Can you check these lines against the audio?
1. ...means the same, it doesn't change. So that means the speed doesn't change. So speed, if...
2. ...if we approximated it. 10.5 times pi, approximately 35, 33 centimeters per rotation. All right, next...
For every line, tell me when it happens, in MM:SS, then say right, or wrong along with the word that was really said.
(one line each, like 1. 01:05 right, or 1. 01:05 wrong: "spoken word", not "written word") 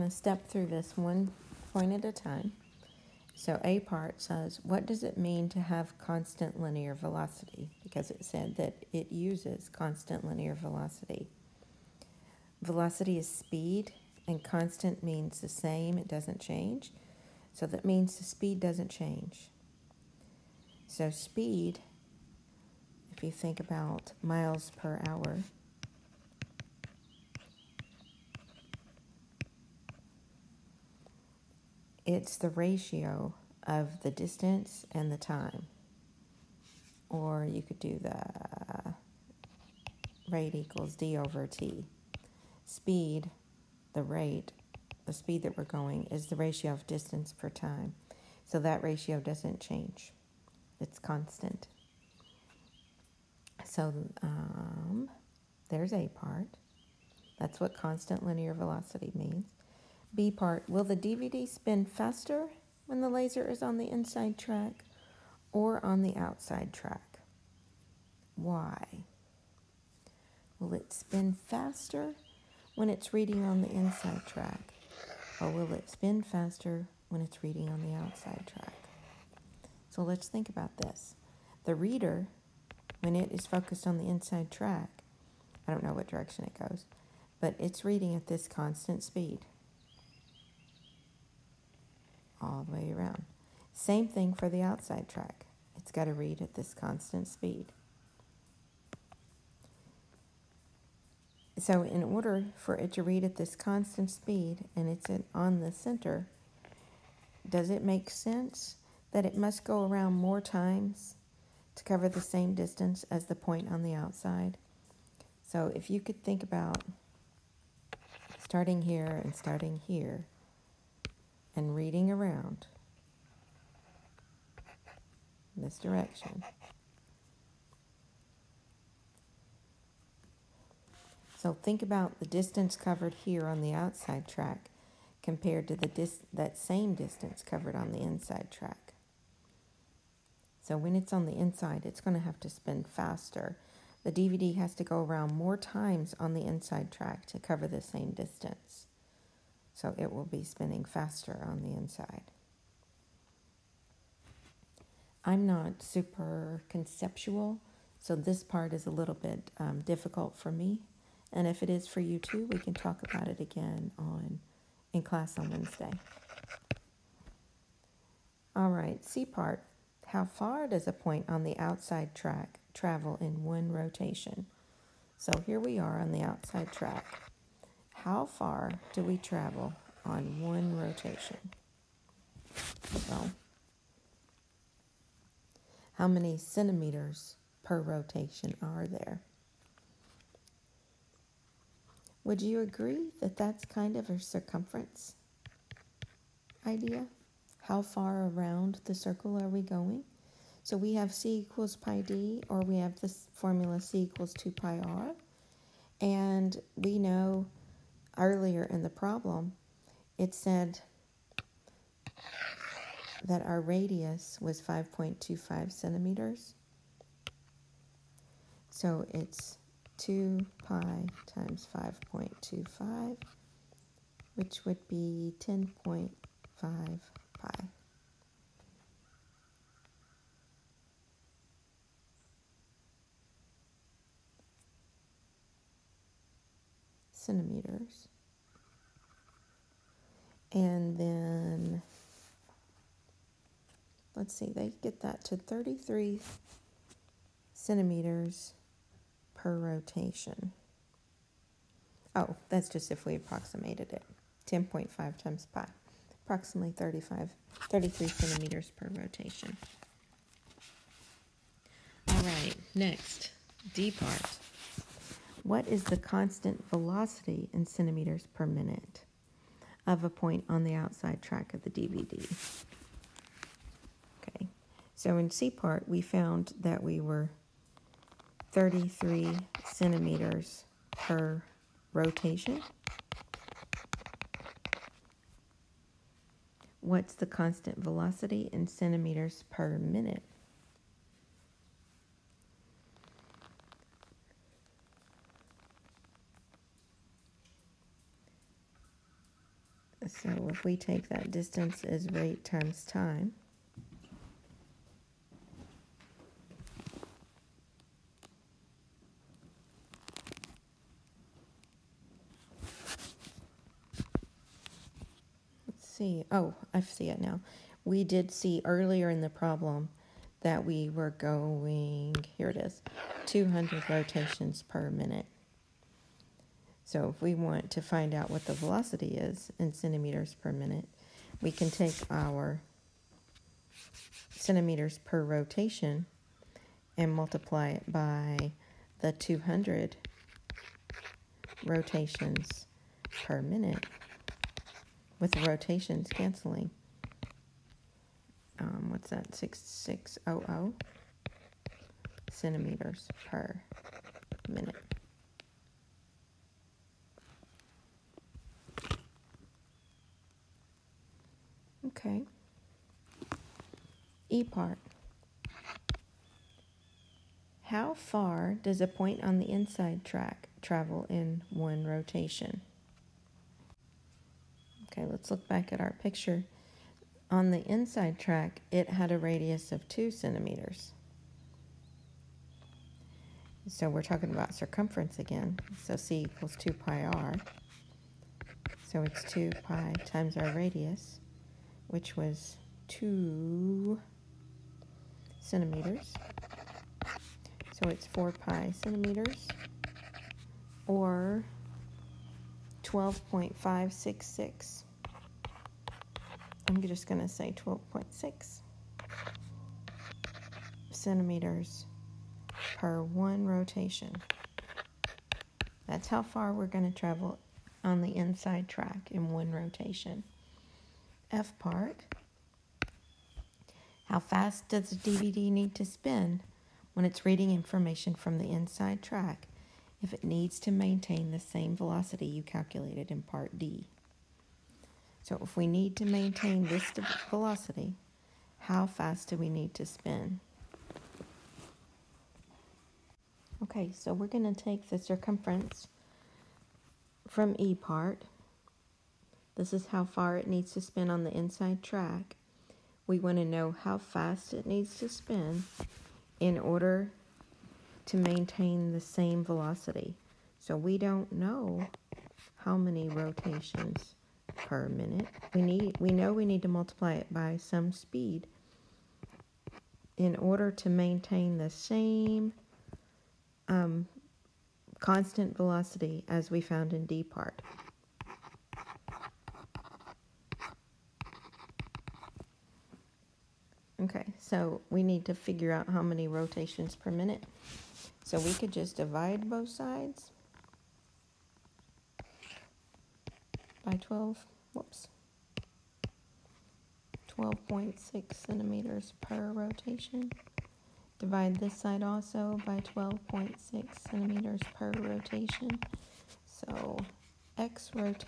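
1. 00:15 right
2. 04:12 right.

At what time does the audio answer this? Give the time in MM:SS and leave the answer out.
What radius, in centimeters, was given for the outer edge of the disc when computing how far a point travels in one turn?
03:34.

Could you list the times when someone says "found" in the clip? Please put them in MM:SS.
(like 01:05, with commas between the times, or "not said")
04:35, 07:56.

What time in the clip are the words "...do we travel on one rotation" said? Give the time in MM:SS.
02:58.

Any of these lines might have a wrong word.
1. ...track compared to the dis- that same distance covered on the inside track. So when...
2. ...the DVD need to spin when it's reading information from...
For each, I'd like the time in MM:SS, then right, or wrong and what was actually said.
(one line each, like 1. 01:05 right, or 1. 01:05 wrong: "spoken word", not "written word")
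1. 02:14 right
2. 07:04 right.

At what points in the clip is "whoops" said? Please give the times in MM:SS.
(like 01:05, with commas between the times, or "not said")
08:14.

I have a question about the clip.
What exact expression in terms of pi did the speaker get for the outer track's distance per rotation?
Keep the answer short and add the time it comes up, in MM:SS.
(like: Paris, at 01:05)
10.5 pi, at 03:45.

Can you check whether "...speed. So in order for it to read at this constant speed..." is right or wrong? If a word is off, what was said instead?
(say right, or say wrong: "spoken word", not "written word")
right.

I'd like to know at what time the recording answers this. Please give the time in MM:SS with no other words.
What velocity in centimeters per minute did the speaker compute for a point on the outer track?
05:49.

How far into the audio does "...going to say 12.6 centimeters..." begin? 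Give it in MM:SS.
06:47.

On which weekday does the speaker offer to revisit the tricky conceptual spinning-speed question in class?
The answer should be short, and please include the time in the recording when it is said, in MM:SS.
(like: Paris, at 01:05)
Wednesday, at 02:45.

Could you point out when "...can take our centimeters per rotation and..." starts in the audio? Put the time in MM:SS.
05:31.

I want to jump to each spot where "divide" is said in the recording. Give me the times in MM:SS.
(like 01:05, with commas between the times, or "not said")
08:08, 08:21.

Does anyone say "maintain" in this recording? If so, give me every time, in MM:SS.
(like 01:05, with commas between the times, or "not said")
07:10, 07:16, 07:38, 07:50.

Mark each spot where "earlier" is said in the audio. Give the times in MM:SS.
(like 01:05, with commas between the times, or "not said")
03:28, 05:18.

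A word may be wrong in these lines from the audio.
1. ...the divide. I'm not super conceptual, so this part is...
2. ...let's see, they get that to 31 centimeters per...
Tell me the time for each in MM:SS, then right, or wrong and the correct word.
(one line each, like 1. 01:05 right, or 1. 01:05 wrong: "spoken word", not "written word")
1. 02:31 wrong: "inside", not "divide"
2. 04:04 wrong: "33", not "31".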